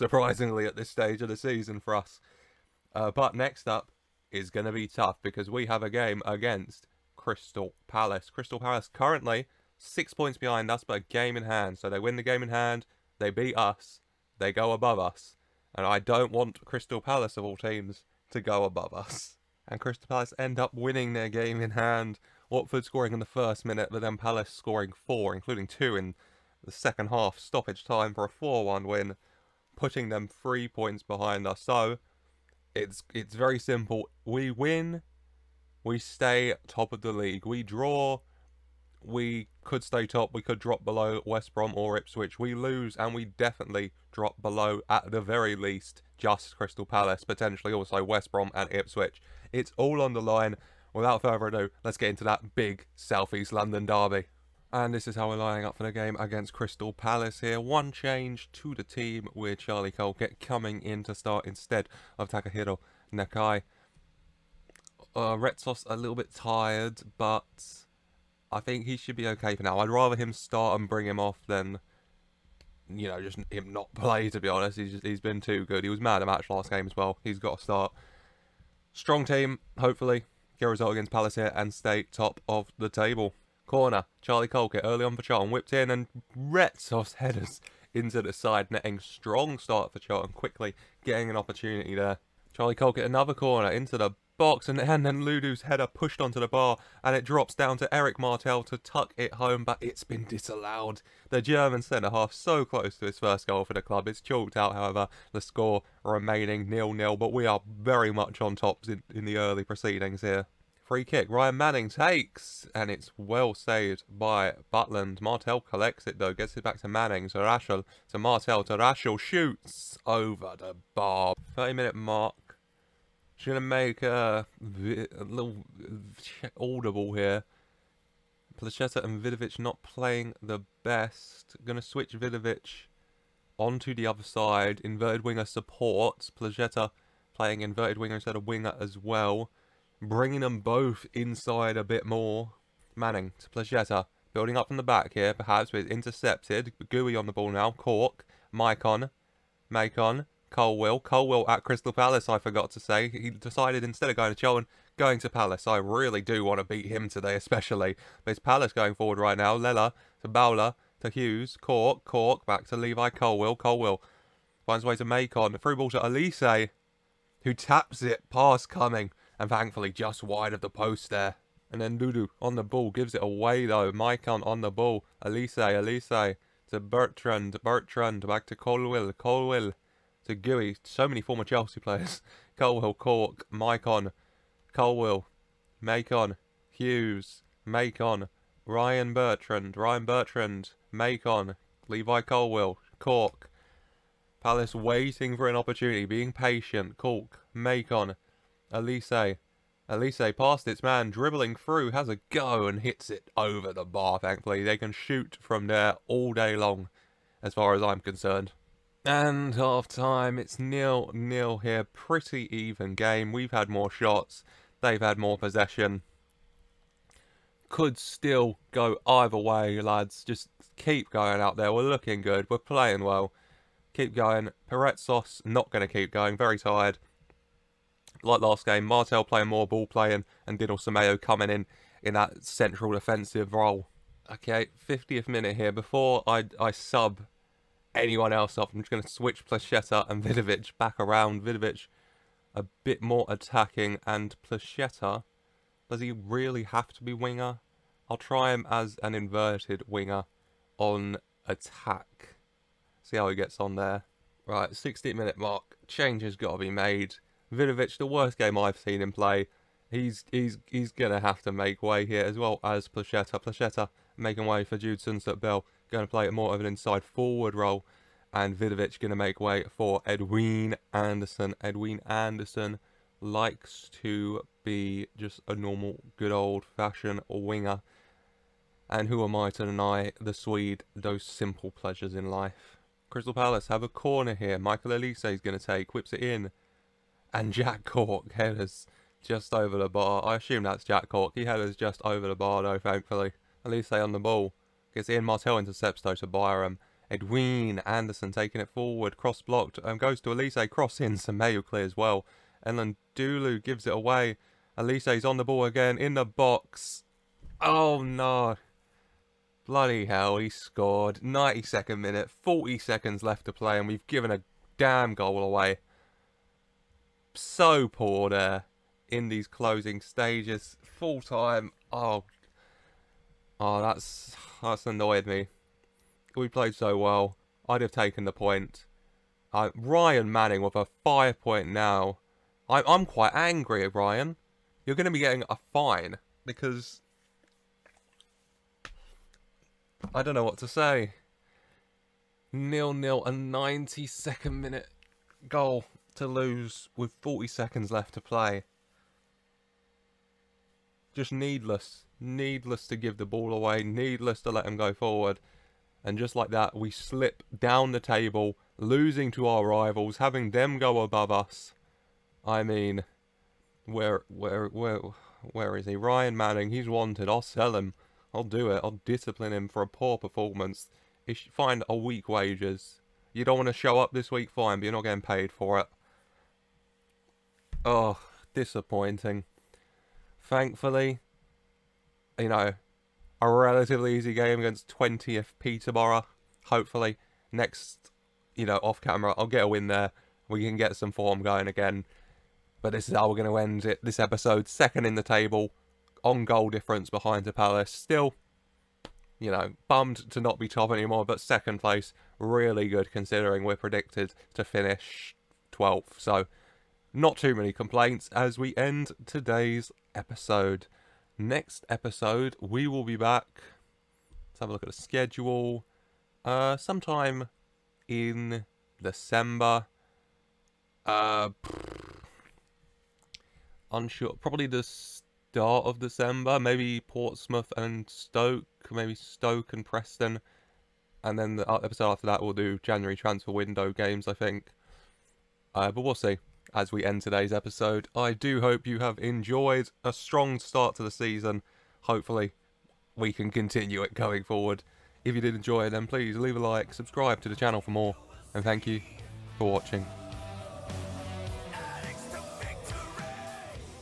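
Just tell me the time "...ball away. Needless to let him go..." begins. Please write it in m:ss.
5:53.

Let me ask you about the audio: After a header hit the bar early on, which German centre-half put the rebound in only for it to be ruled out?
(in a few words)
Eric Martel.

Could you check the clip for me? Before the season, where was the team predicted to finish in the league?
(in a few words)
12th.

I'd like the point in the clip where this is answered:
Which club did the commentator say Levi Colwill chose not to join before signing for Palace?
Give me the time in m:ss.
2:34.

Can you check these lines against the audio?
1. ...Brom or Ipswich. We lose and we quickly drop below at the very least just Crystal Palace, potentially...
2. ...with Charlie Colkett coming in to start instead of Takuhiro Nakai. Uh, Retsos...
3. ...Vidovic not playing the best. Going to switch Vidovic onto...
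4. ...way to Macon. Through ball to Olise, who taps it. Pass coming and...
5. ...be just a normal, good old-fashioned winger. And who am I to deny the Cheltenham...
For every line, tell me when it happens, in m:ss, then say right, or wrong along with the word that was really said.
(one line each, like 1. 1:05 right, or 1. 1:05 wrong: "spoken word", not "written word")
1. 0:41 wrong: "definitely", not "quickly"
2. 0:59 right
3. 2:09 right
4. 2:44 right
5. 4:34 wrong: "Swede", not "Cheltenham".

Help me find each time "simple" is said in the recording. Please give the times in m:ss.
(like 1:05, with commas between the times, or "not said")
0:33, 4:41.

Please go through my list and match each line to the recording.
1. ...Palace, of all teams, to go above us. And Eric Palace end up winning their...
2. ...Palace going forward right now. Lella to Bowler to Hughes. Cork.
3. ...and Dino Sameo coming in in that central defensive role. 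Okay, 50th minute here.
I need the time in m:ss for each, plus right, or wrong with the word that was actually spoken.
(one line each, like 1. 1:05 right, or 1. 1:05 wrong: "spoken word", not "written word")
1. 0:17 wrong: "Crystal", not "Eric"
2. 2:38 right
3. 3:50 right.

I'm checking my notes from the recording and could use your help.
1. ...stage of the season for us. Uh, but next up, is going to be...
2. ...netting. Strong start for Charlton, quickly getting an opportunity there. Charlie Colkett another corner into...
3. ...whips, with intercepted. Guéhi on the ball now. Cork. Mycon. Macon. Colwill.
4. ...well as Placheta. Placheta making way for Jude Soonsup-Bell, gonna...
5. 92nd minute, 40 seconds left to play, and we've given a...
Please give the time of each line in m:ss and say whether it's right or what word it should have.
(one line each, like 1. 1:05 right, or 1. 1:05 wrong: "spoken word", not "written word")
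1. 0:00 right
2. 1:28 right
3. 2:25 wrong: "perhaps", not "whips"
4. 4:22 right
5. 5:11 right.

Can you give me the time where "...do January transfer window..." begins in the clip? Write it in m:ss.
7:12.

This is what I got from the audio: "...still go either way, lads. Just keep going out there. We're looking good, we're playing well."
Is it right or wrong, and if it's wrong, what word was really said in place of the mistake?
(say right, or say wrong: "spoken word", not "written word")
right.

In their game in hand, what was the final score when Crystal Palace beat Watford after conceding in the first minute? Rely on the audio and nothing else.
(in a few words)
4-1.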